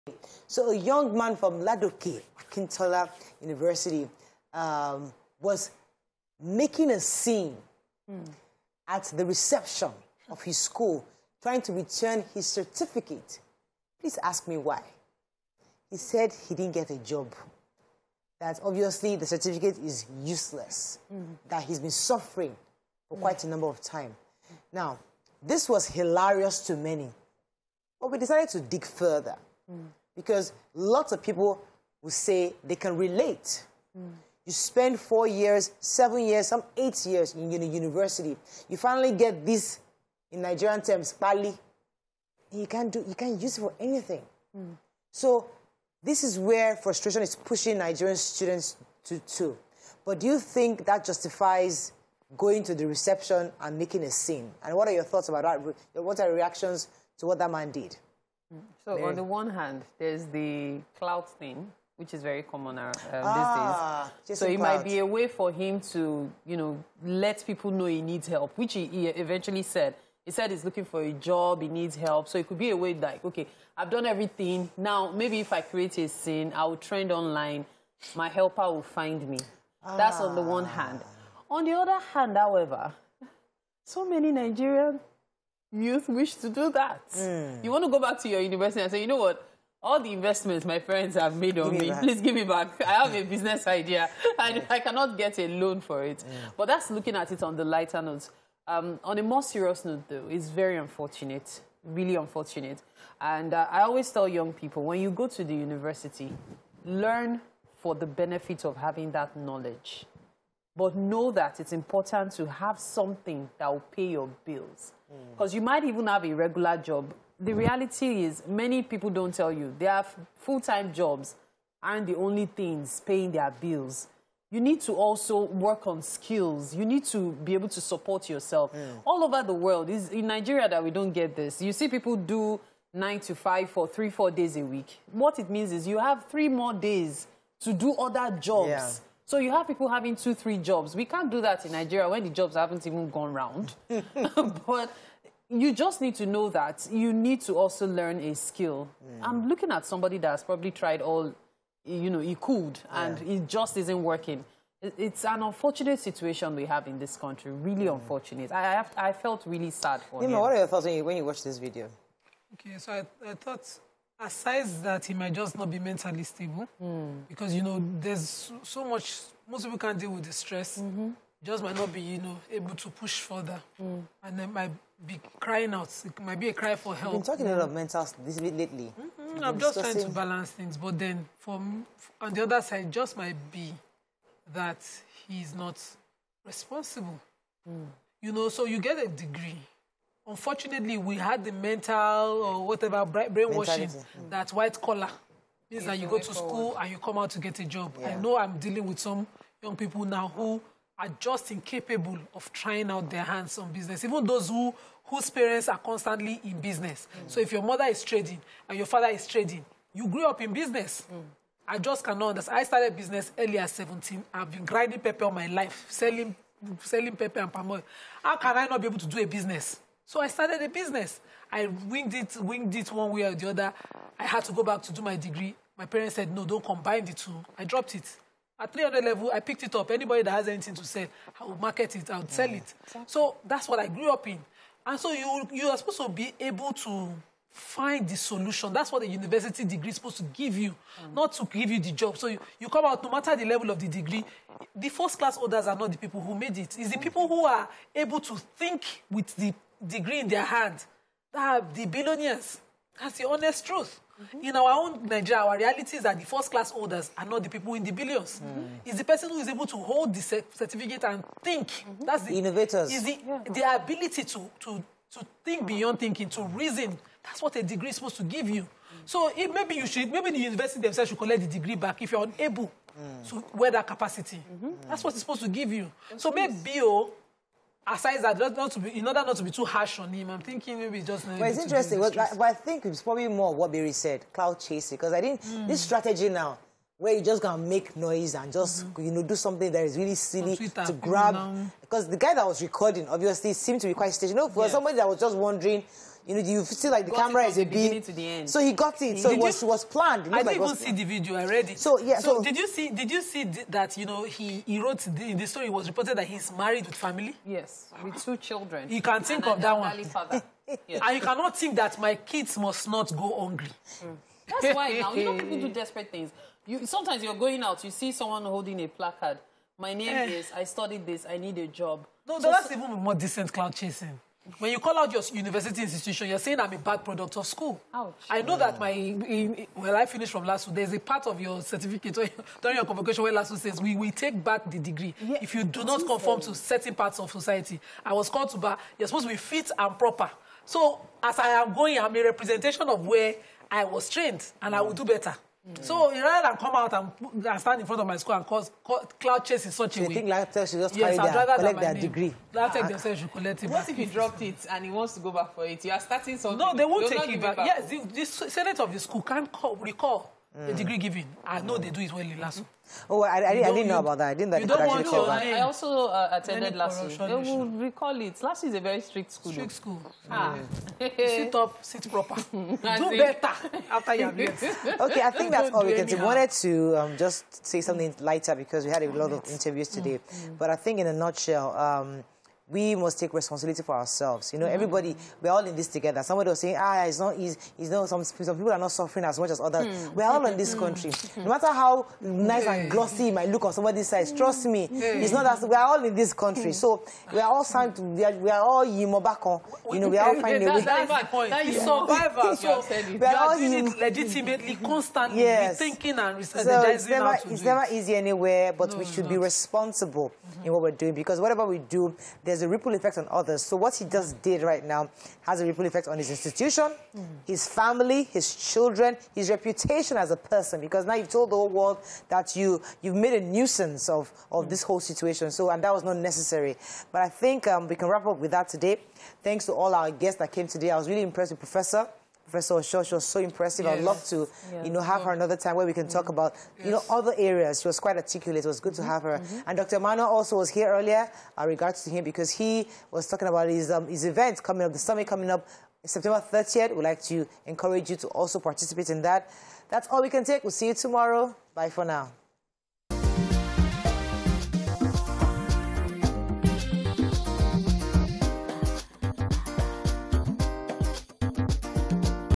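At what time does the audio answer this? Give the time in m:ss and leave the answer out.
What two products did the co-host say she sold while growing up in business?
3:37.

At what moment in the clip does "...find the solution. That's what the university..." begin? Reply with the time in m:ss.
3:57.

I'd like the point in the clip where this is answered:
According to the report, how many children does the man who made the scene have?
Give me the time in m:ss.
5:08.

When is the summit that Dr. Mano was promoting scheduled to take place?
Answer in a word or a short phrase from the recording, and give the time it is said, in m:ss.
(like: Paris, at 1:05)
September 30th, at 7:26.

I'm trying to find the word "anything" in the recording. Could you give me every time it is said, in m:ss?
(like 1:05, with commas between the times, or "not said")
0:43, 3:50.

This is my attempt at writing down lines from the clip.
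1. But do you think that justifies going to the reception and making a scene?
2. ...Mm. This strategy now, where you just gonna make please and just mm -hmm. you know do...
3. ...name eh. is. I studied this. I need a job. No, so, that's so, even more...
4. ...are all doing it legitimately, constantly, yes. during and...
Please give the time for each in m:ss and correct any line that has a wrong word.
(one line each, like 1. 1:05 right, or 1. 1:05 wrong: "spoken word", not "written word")
1. 0:50 right
2. 4:45 wrong: "noise", not "please"
3. 5:19 right
4. 6:43 wrong: "rethinking", not "during".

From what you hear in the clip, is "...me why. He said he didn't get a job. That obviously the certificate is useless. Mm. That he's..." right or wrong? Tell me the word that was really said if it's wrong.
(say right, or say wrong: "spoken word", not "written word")
right.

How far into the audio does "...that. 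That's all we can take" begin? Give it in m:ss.
7:29.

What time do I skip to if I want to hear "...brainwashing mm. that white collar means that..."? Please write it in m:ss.
3:13.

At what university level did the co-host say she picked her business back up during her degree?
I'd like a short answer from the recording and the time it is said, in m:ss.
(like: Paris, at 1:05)
300 level, at 3:48.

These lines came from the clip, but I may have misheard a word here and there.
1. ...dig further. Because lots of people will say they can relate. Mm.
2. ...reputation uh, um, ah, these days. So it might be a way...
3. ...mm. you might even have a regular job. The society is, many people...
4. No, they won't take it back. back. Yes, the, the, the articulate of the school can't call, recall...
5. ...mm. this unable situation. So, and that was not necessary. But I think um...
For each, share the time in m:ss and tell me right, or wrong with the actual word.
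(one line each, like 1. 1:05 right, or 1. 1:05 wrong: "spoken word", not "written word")
1. 0:28 right
2. 1:02 wrong: "common", not "reputation"
3. 1:55 wrong: "reality", not "society"
4. 5:56 wrong: "senate", not "articulate"
5. 7:04 wrong: "whole", not "unable".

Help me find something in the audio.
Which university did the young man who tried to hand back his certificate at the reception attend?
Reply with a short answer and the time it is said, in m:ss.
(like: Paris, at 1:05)
Ladoke Akintola University, at 0:01.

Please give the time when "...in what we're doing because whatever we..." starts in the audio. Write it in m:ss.
6:50.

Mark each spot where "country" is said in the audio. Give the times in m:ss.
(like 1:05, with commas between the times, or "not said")
2:37, 6:30, 6:36.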